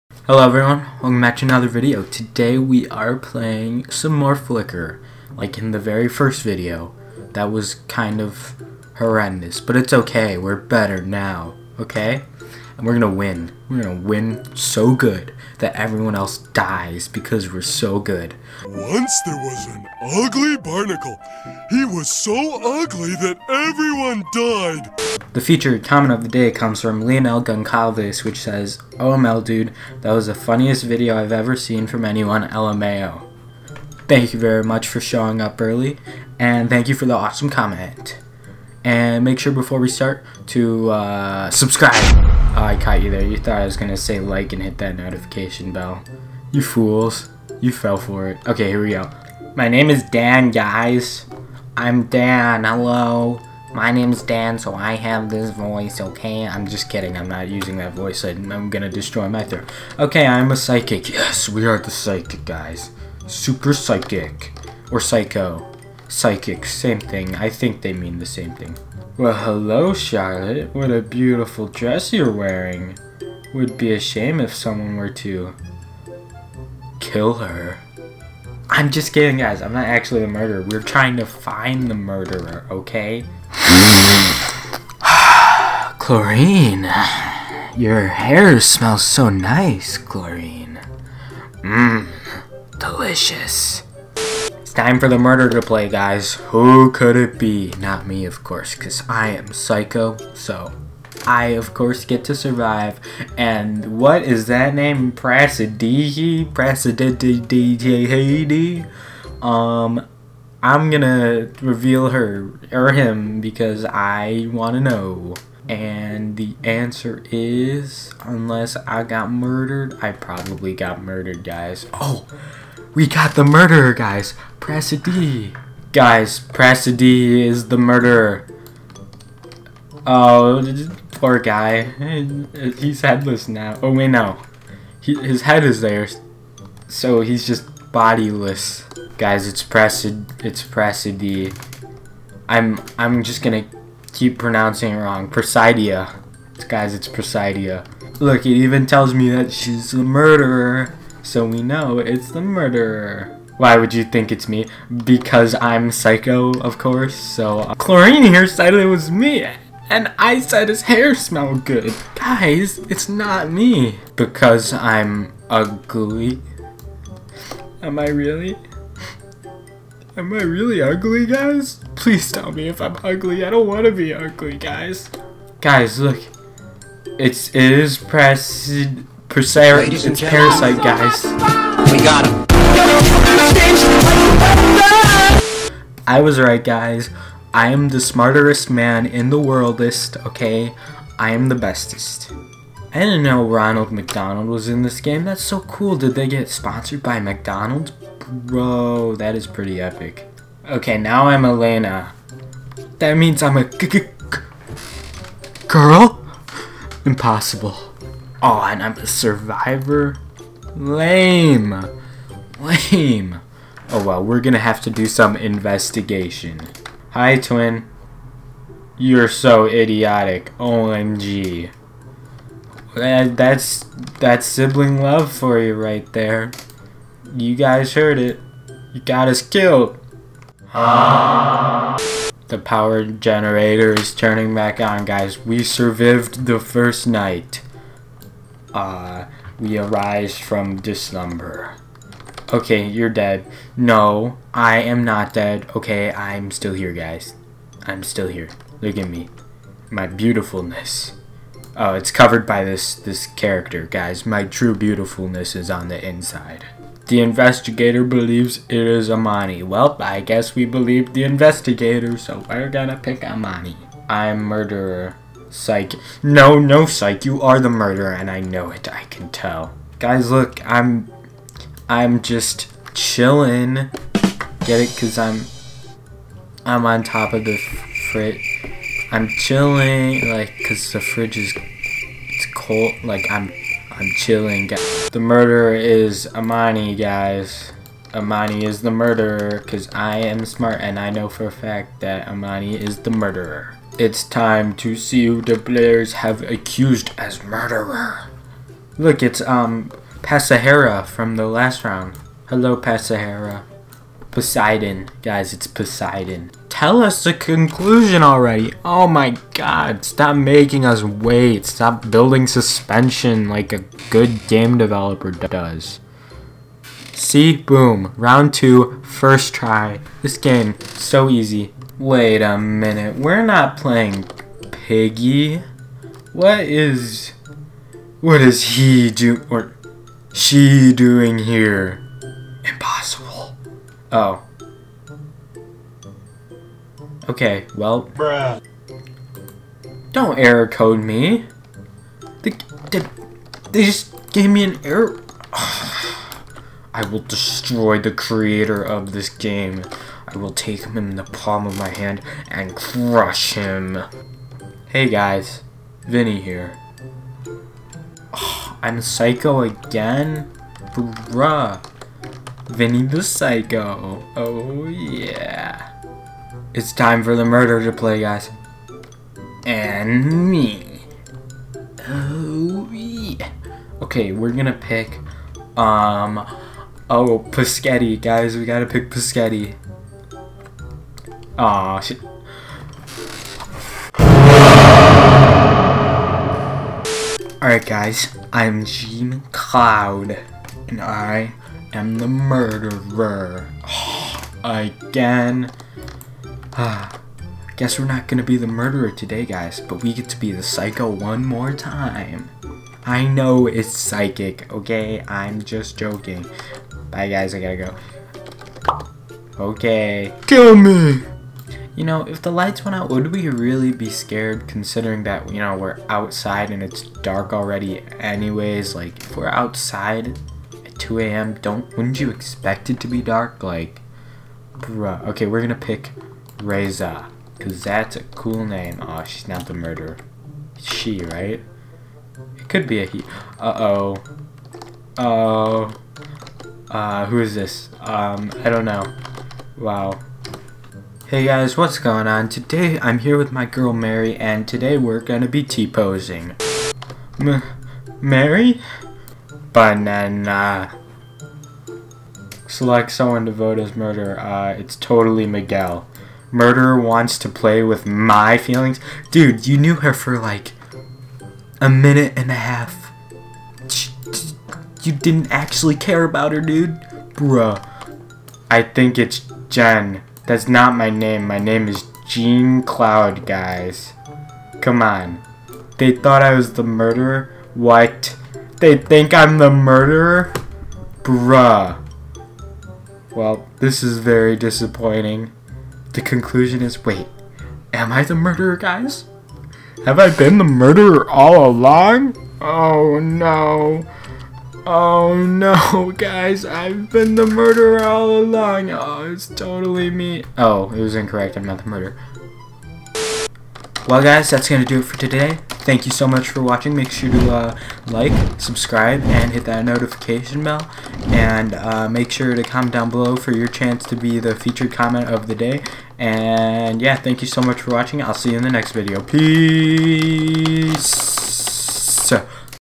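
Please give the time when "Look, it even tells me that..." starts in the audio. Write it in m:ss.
2:28.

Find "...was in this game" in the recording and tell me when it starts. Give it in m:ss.
3:14.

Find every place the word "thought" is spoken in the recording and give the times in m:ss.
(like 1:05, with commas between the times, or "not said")
0:43, 7:56.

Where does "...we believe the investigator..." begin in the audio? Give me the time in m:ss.
4:20.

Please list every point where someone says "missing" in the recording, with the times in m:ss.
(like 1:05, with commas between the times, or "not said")
not said.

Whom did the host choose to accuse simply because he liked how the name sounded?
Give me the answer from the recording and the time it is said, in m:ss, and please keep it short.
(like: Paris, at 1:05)
Reza, at 7:06.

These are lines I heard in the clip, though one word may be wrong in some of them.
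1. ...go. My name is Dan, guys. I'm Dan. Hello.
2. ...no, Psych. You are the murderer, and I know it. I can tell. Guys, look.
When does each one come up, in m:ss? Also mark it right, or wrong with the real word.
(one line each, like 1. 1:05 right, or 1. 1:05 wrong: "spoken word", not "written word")
1. 0:48 right
2. 4:26 right.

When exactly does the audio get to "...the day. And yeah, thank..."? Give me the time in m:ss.
8:35.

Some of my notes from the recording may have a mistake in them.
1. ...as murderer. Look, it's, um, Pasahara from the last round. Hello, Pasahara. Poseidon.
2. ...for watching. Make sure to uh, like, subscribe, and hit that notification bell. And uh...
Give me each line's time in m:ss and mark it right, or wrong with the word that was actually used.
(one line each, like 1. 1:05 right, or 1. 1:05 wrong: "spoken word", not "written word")
1. 4:57 right
2. 8:26 right.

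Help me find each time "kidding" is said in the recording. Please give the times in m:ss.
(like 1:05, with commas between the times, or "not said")
0:56, 1:19.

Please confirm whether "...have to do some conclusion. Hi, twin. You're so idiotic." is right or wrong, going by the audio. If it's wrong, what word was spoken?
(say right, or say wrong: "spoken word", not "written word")
wrong: "investigation", not "conclusion".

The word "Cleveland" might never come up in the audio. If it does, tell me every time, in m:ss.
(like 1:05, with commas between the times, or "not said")
not said.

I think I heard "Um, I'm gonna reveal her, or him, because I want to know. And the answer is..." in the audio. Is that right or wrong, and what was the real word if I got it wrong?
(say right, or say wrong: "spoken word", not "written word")
right.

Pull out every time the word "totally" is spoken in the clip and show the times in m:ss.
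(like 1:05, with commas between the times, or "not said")
7:34, 8:19.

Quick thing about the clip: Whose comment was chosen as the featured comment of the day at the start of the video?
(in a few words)
Leonel Goncalves.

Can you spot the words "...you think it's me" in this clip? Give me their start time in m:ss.
2:33.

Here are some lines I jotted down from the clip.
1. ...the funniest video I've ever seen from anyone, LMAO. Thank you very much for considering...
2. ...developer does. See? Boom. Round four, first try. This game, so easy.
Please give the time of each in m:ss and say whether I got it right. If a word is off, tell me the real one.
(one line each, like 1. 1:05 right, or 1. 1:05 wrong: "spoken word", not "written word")
1. 0:30 wrong: "showing", not "considering"
2. 5:14 wrong: "two", not "four".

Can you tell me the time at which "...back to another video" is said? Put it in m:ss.
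0:01.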